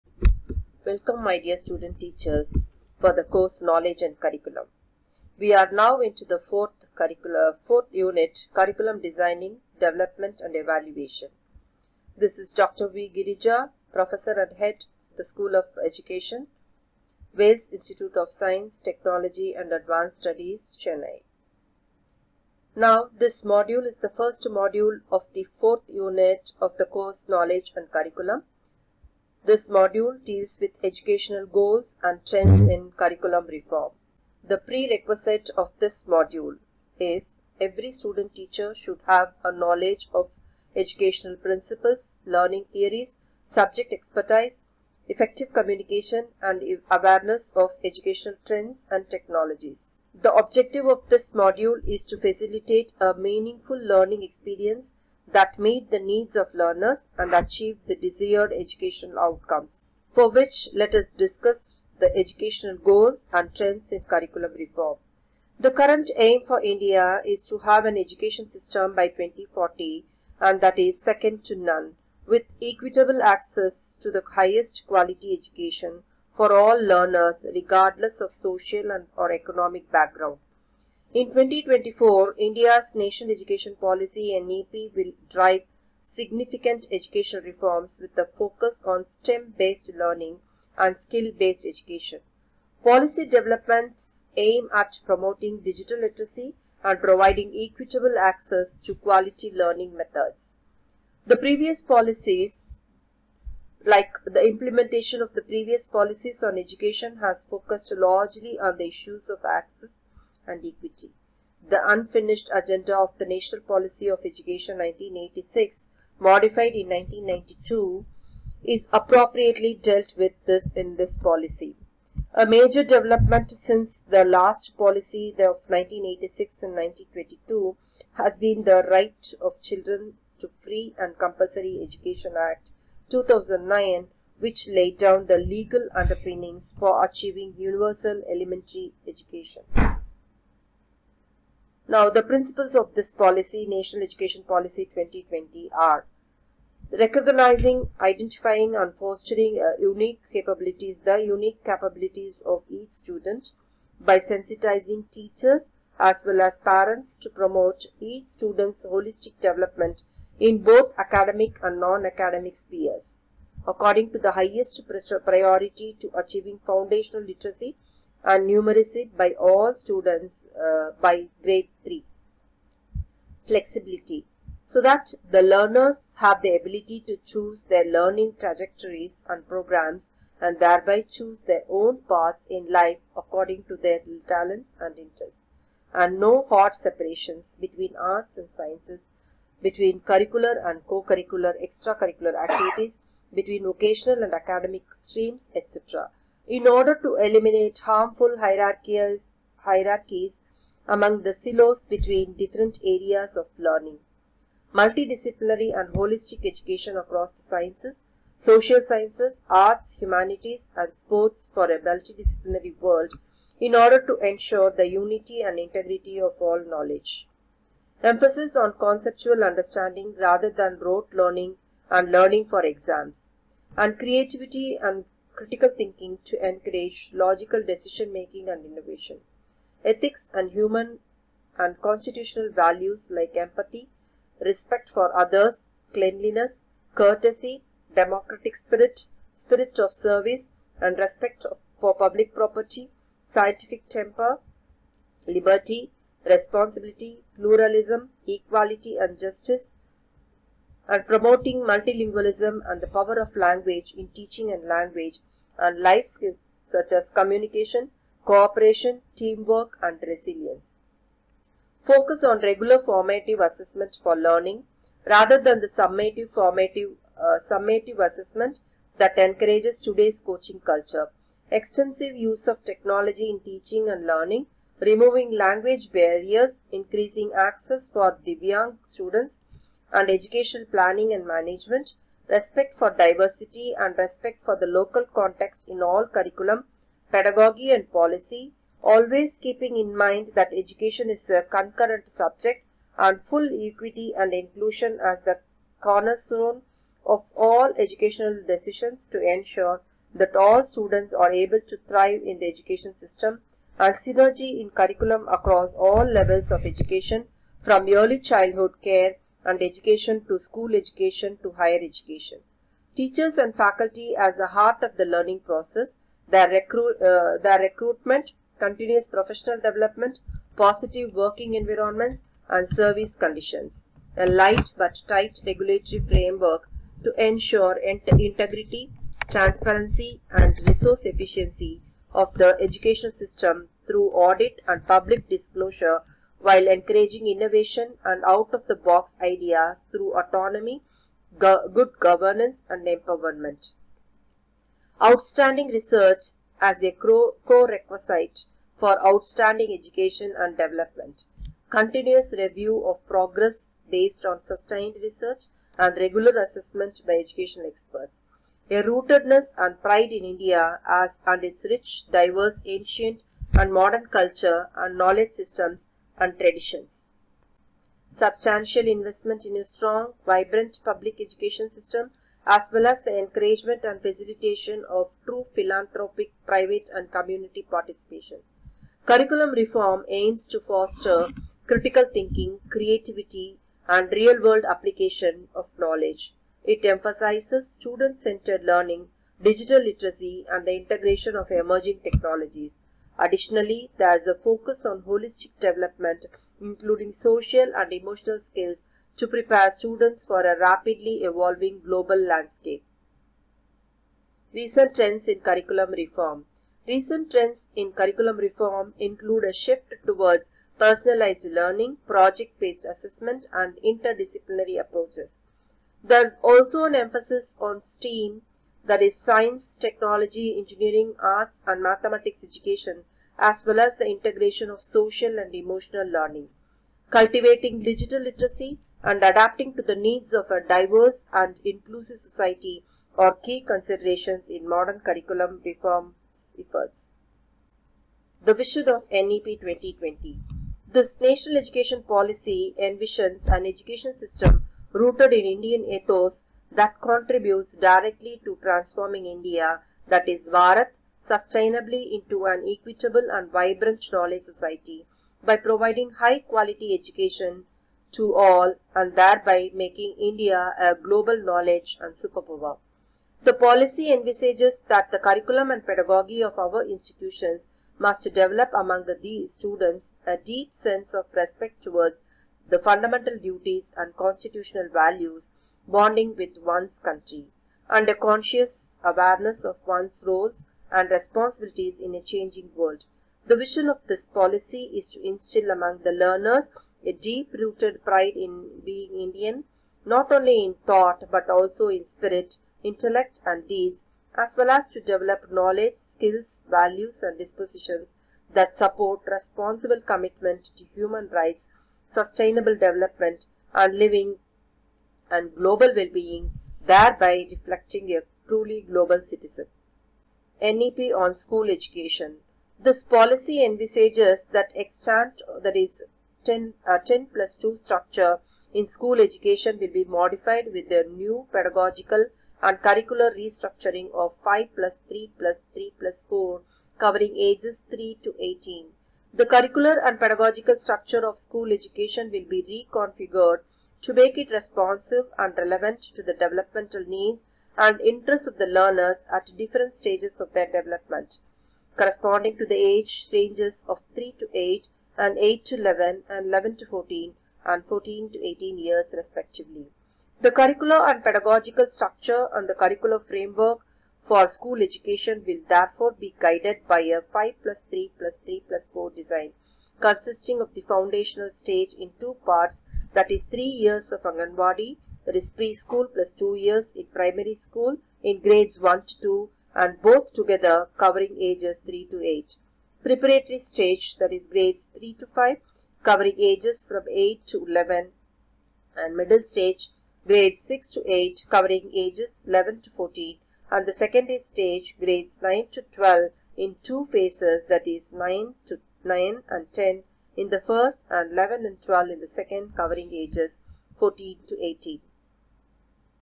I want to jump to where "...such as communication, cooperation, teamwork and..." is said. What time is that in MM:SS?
04:16.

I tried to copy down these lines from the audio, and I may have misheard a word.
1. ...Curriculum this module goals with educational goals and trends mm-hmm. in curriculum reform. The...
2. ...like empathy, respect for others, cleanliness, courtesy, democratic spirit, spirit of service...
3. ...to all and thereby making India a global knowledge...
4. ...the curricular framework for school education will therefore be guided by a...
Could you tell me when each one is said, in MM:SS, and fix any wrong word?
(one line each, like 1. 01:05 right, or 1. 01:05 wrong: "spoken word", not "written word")
1. 00:27 wrong: "deals", not "goals"
2. 03:53 right
3. 07:38 right
4. 09:12 right.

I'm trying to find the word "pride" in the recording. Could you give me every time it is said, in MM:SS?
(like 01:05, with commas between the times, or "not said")
05:59, 08:08.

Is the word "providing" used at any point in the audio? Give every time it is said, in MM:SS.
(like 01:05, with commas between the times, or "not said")
01:37, 07:35.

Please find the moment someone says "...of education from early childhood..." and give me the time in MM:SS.
05:06.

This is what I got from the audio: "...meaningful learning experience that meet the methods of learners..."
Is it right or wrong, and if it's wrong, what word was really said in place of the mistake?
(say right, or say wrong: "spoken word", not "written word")
wrong: "needs", not "methods".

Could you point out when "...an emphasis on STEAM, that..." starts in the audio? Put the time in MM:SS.
06:56.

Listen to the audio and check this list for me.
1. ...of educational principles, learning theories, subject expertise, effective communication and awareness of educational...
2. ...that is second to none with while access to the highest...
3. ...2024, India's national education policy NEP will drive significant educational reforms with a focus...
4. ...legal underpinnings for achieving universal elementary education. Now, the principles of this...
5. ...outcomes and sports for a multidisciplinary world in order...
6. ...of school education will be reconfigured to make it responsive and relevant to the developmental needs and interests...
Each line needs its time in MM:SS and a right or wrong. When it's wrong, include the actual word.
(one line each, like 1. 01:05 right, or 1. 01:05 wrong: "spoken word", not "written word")
1. 00:40 right
2. 01:10 wrong: "equitable", not "while"
3. 01:21 right
4. 02:15 right
5. 03:29 wrong: "humanities", not "outcomes"
6. 08:51 right.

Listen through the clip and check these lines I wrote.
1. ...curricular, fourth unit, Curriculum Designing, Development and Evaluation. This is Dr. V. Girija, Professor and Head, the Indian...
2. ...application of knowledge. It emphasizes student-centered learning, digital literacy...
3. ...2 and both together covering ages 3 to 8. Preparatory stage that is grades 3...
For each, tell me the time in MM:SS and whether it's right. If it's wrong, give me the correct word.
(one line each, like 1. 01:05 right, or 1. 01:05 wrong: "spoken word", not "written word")
1. 00:06 wrong: "School", not "Indian"
2. 06:24 right
3. 09:29 right.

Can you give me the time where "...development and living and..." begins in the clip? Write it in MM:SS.
08:22.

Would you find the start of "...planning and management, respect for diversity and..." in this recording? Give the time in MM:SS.
04:40.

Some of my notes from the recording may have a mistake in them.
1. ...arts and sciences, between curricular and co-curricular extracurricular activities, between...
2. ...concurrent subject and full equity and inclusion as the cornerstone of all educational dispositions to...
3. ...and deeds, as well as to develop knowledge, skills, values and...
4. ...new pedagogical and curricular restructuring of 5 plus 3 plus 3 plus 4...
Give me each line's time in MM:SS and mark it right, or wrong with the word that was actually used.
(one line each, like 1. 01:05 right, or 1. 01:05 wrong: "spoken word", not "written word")
1. 03:07 right
2. 04:51 wrong: "decisions", not "dispositions"
3. 08:13 right
4. 08:41 right.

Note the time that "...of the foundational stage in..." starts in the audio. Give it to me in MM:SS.
09:20.